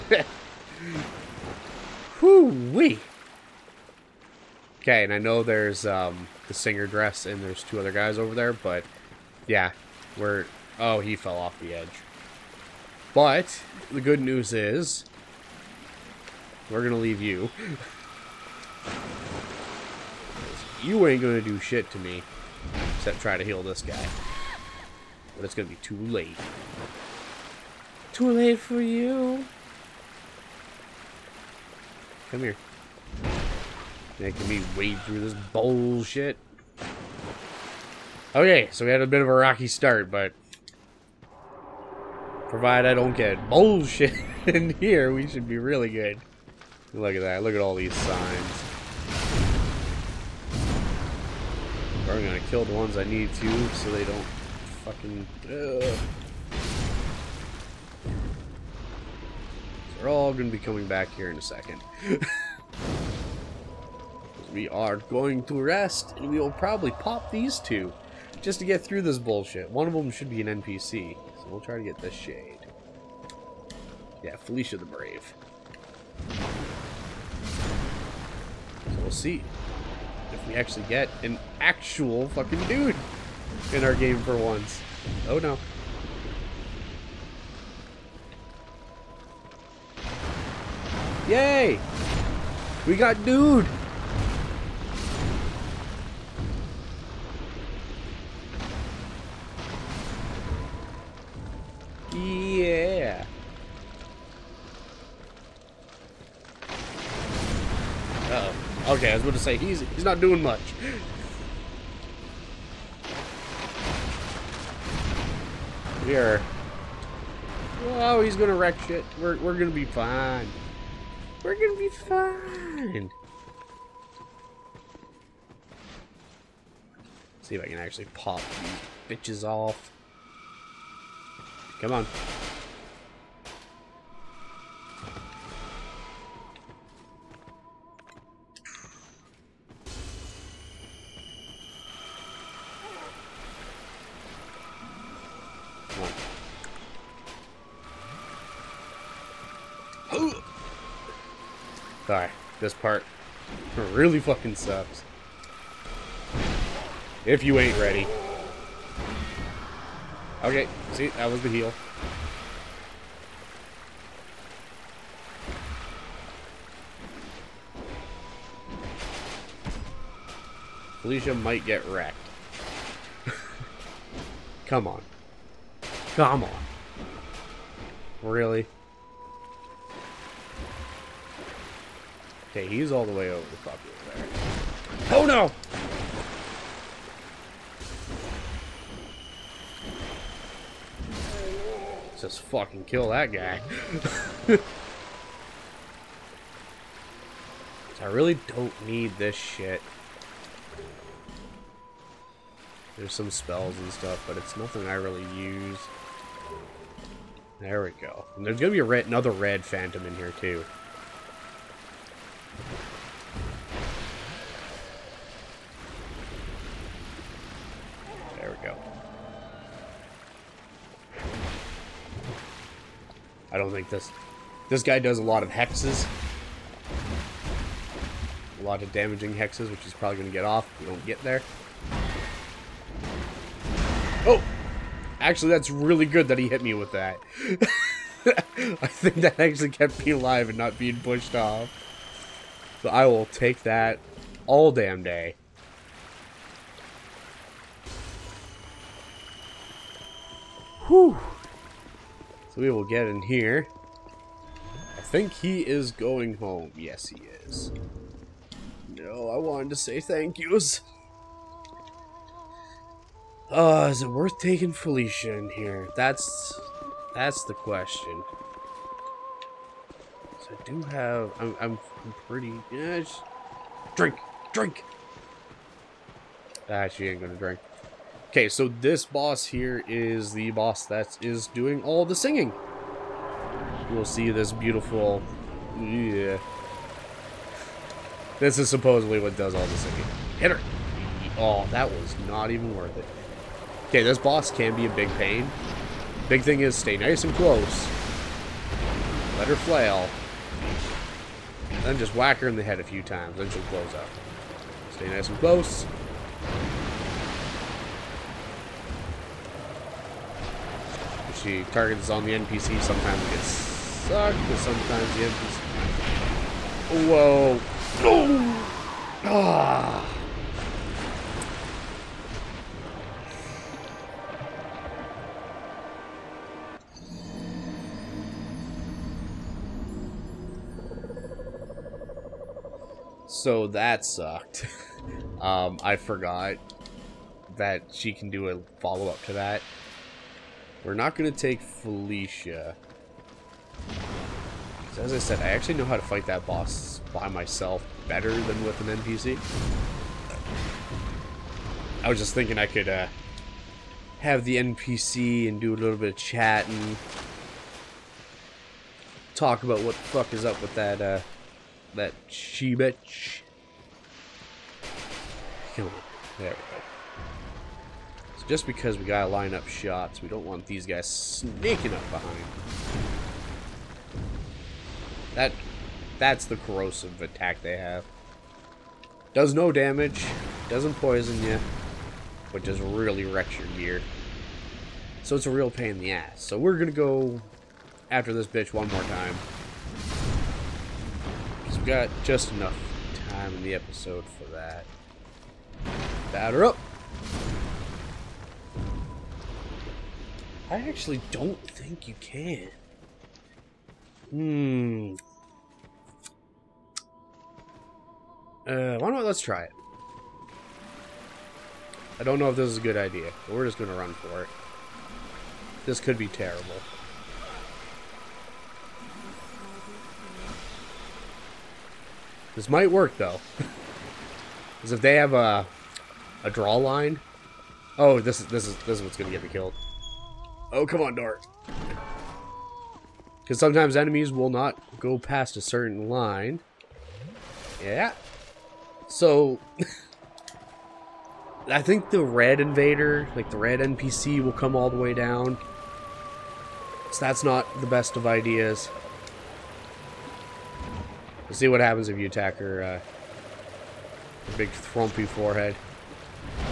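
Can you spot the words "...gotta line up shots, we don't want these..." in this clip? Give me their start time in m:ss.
6:09.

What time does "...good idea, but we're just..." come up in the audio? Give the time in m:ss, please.
6:52.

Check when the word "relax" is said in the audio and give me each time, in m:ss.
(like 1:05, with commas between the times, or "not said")
not said.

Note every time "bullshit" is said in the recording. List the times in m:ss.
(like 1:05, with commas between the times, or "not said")
0:35, 0:43, 1:09.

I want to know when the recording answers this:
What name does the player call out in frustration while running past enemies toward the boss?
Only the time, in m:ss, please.
7:11.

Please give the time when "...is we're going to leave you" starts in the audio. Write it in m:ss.
0:14.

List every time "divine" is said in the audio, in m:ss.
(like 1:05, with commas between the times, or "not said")
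not said.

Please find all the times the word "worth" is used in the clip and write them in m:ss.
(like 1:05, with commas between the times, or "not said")
4:24, 4:52.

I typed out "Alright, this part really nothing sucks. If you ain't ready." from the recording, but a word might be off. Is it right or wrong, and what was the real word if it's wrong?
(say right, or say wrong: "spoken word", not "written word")
wrong: "fucking", not "nothing".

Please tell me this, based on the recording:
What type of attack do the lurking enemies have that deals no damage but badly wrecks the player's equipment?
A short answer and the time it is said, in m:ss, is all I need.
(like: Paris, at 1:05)
Corrosive attack, at 6:16.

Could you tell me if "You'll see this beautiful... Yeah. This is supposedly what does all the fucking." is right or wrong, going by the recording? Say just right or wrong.
wrong.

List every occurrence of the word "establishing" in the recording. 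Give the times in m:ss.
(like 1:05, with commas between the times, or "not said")
not said.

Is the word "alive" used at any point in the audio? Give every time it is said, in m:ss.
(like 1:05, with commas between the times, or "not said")
4:00.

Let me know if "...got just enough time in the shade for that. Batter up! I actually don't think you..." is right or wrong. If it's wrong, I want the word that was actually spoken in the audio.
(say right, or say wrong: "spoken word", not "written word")
wrong: "episode", not "shade".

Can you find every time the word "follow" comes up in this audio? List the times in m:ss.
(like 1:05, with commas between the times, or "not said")
5:38.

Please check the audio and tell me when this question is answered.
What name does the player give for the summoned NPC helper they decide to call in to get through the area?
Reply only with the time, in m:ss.
1:14.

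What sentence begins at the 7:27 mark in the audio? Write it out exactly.
So that's not the best of ideas.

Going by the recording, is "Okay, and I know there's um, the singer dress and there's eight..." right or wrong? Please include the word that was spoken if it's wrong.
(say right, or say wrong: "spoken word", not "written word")
wrong: "two", not "eight".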